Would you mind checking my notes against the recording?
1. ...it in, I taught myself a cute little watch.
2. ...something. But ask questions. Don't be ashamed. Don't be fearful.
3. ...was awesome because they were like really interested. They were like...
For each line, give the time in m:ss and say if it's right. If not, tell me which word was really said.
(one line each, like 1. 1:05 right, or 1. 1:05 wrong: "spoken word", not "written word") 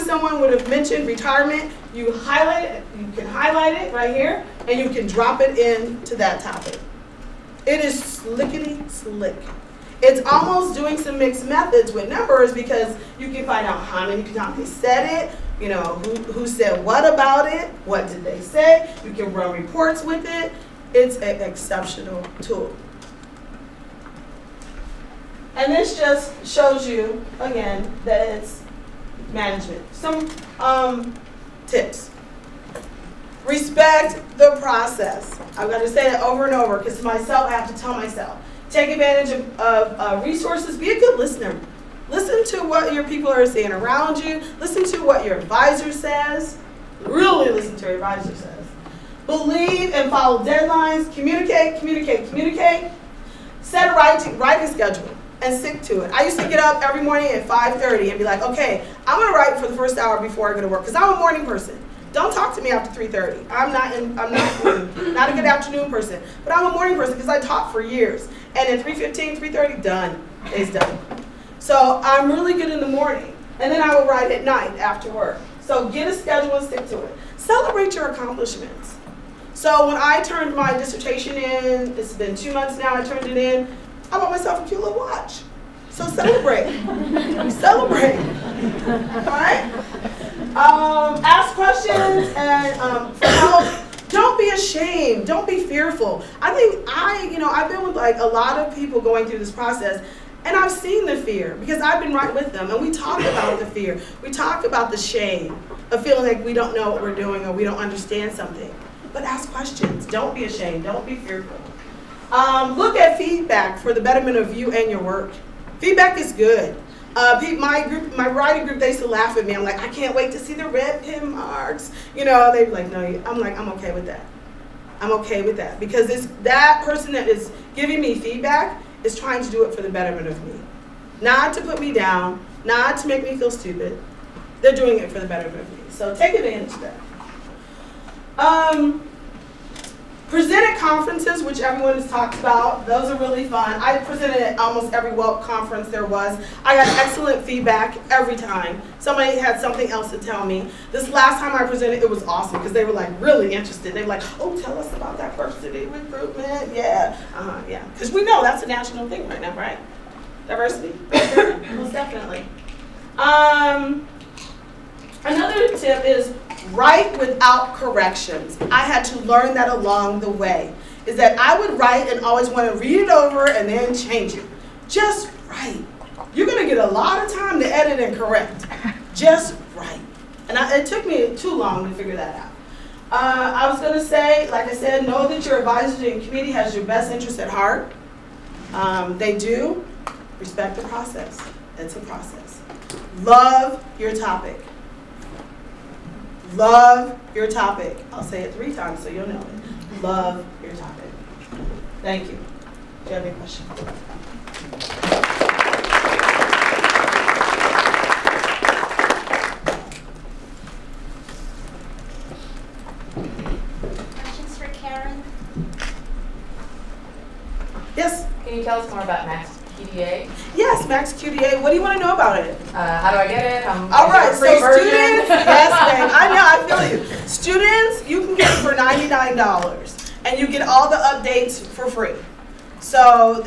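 1. 1:23 wrong: "bought", not "taught"
2. 1:48 right
3. 2:32 right.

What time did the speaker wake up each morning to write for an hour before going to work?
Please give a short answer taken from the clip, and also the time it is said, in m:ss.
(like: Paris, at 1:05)
5:30, at 0:57.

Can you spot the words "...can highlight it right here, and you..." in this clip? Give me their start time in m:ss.
0:03.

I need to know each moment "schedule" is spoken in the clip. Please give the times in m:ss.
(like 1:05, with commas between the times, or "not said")
0:54, 1:16.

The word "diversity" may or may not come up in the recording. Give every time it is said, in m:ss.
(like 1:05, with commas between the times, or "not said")
2:35, 2:40.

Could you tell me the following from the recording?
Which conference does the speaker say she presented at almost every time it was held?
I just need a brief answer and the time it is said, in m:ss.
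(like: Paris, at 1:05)
WELP, at 2:25.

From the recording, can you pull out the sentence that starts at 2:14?
They're doing it for the betterment of me.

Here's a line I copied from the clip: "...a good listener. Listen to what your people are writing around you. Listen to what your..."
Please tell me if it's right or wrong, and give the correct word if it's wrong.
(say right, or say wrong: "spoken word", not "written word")
wrong: "saying", not "writing".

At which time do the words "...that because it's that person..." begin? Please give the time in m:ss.
2:05.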